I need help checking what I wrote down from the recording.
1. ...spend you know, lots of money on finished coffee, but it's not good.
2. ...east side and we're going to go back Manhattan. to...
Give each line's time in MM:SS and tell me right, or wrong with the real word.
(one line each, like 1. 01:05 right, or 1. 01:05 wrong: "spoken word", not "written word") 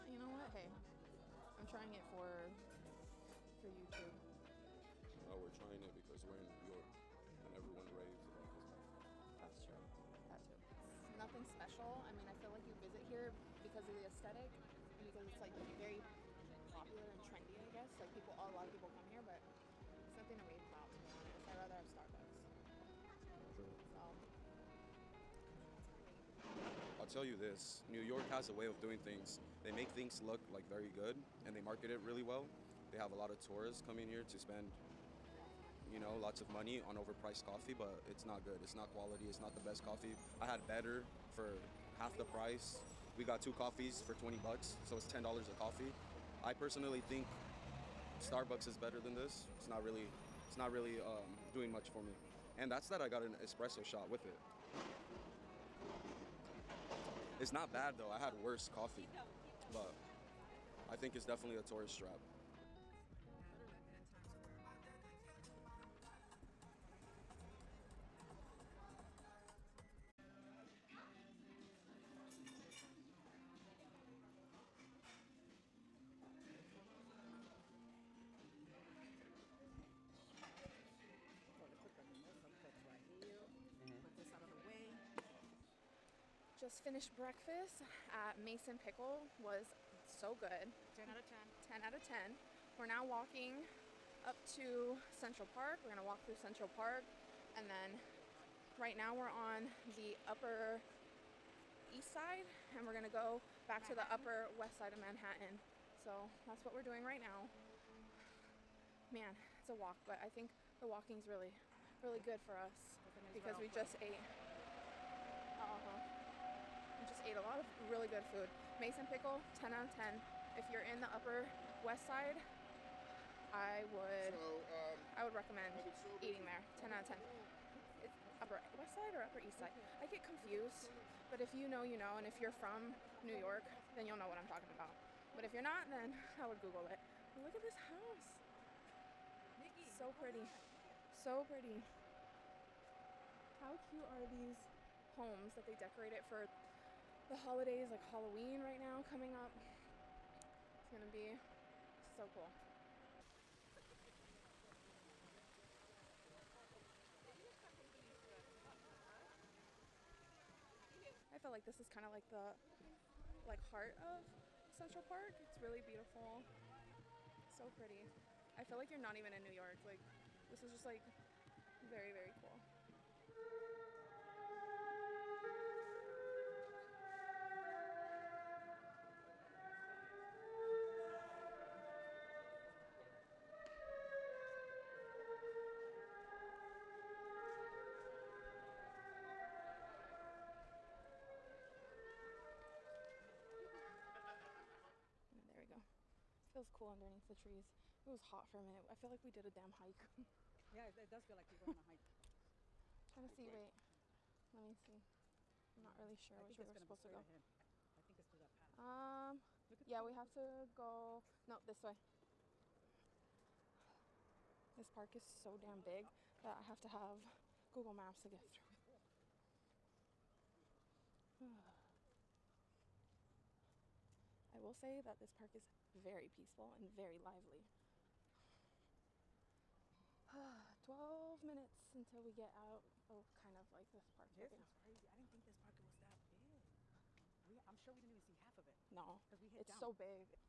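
1. 00:34 wrong: "overpriced", not "finished"
2. 01:41 right.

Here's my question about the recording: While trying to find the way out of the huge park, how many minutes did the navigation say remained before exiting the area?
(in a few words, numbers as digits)
12.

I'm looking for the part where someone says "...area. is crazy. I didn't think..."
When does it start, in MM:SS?
03:54.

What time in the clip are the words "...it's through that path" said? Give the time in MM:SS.
03:28.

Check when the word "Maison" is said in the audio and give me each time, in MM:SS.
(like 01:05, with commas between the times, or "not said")
01:28, 01:58.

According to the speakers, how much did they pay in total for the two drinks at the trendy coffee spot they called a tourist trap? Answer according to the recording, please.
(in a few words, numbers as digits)
$20.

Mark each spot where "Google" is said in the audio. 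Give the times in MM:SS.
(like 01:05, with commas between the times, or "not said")
02:16, 03:37.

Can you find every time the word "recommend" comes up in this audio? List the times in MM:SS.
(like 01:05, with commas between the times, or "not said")
02:05.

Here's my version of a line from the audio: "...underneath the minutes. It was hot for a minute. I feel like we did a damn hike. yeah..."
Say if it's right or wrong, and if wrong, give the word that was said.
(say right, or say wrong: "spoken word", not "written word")
wrong: "trees", not "minutes".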